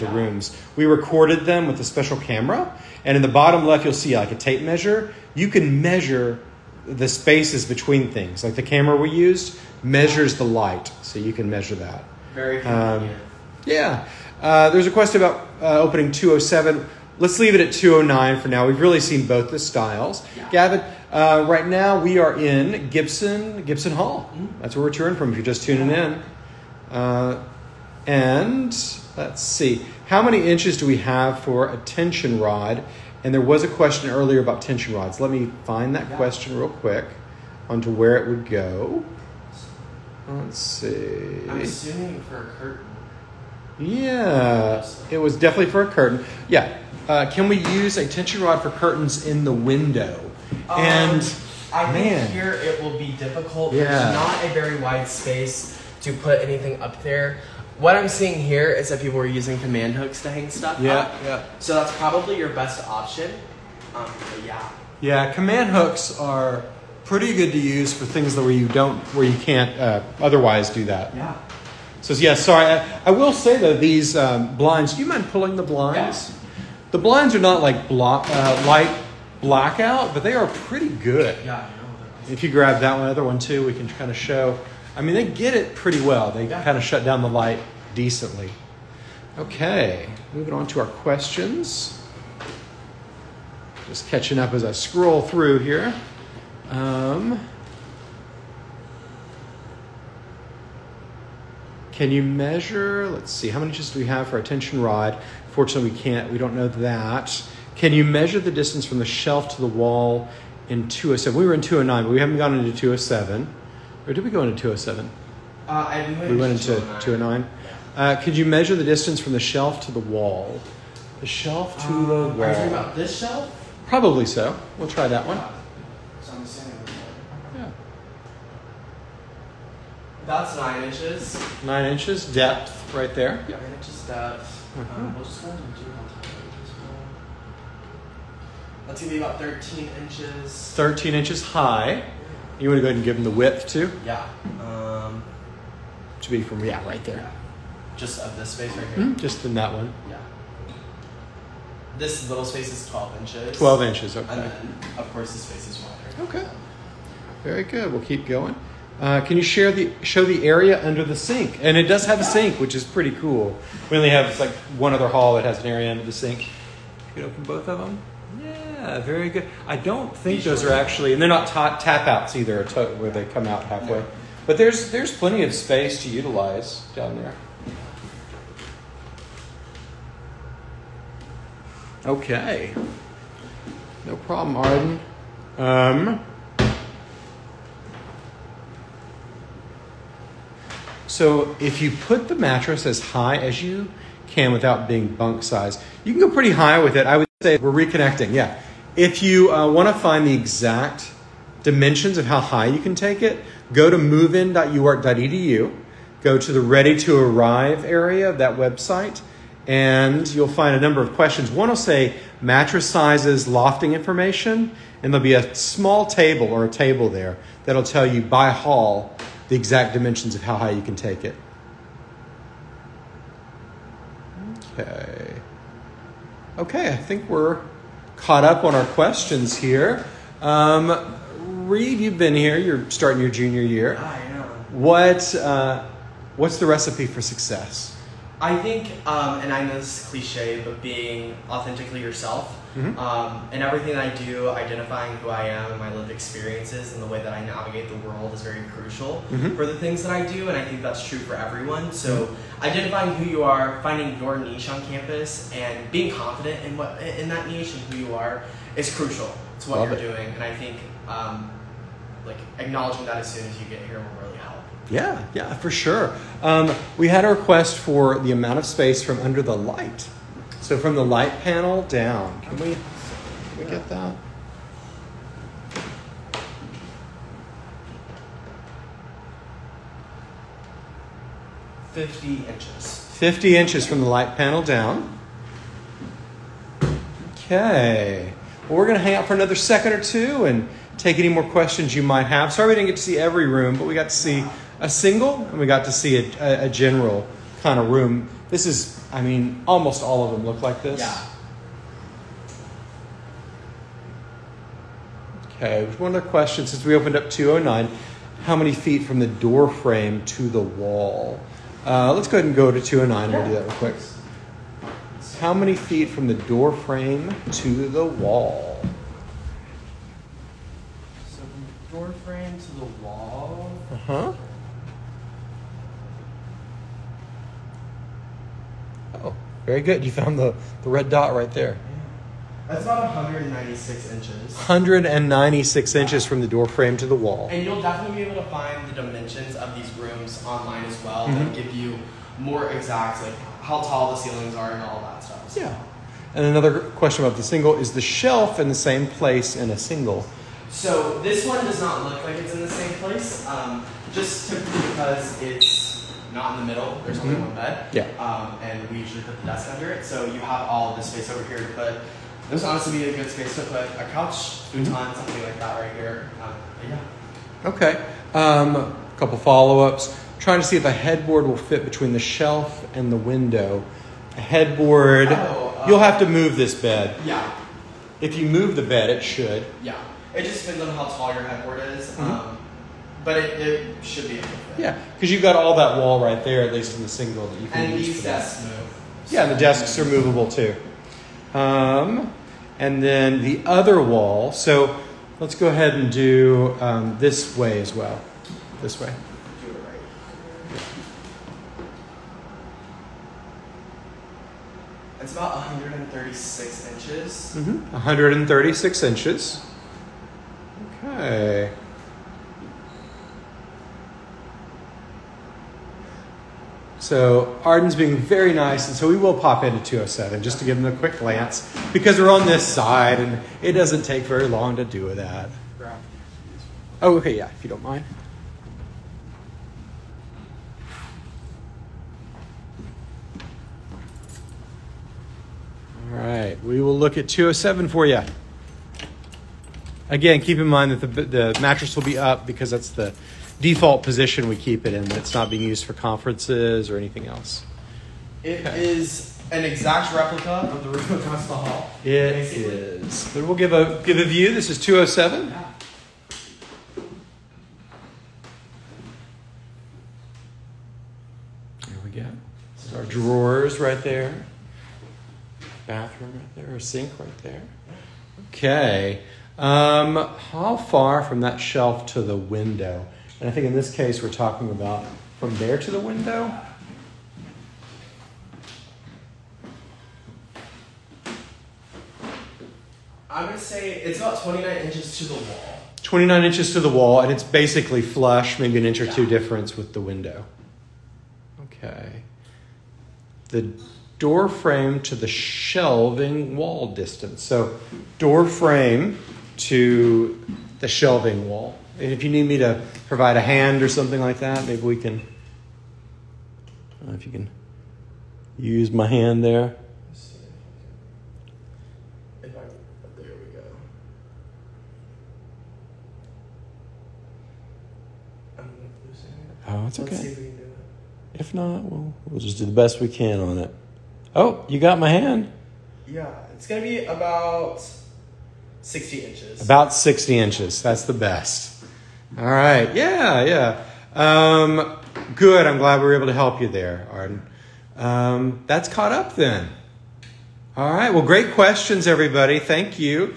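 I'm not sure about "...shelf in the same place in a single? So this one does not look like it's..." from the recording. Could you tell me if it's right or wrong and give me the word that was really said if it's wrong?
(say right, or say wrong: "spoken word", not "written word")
right.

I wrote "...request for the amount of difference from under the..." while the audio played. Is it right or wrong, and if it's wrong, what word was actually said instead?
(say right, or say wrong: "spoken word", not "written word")
wrong: "space", not "difference".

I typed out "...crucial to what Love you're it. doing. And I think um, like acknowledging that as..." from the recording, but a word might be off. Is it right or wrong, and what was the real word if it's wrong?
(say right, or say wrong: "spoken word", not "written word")
right.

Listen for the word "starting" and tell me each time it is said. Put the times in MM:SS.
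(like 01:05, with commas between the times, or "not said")
03:52.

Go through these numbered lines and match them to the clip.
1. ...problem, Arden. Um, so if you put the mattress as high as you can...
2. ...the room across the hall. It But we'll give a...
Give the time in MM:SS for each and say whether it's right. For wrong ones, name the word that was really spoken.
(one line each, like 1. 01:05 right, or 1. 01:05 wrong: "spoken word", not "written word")
1. 03:04 right
2. 07:30 right.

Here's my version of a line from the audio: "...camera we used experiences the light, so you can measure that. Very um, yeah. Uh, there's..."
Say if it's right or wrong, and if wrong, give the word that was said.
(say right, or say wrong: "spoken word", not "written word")
wrong: "measures", not "experiences".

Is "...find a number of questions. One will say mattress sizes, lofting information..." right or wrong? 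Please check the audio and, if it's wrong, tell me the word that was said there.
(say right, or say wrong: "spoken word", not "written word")
right.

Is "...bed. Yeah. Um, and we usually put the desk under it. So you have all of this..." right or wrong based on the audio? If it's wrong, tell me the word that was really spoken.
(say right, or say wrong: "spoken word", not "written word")
right.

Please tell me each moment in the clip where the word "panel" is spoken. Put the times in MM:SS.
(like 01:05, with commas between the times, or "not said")
04:31, 04:44.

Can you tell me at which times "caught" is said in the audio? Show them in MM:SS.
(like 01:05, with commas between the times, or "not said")
03:48, 08:58.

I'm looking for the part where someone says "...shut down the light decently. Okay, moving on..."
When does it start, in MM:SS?
01:26.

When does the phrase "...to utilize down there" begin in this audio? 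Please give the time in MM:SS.
02:56.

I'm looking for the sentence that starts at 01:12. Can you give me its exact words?
I, I will say though, these um, blinds.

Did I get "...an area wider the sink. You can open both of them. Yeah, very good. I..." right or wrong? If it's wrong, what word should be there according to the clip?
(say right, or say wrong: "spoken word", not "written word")
wrong: "under", not "wider".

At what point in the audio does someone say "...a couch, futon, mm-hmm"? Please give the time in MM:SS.
06:03.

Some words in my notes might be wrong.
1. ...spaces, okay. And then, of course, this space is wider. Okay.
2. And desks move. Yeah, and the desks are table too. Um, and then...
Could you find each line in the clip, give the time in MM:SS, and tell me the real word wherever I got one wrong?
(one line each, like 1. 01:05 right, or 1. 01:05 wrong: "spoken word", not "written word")
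1. 02:33 wrong: "inches", not "spaces"
2. 06:28 wrong: "movable", not "table".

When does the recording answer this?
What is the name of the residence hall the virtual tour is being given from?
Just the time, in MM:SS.
00:22.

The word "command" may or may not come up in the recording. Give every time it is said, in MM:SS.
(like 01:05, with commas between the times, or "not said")
00:59, 01:05.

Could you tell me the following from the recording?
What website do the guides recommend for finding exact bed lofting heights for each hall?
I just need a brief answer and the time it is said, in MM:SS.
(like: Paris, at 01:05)
movein.uark.edu, at 03:23.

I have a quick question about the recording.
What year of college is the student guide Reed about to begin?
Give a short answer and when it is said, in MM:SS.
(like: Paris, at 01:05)
Junior year, at 03:53.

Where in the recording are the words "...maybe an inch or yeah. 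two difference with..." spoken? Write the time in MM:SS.
08:08.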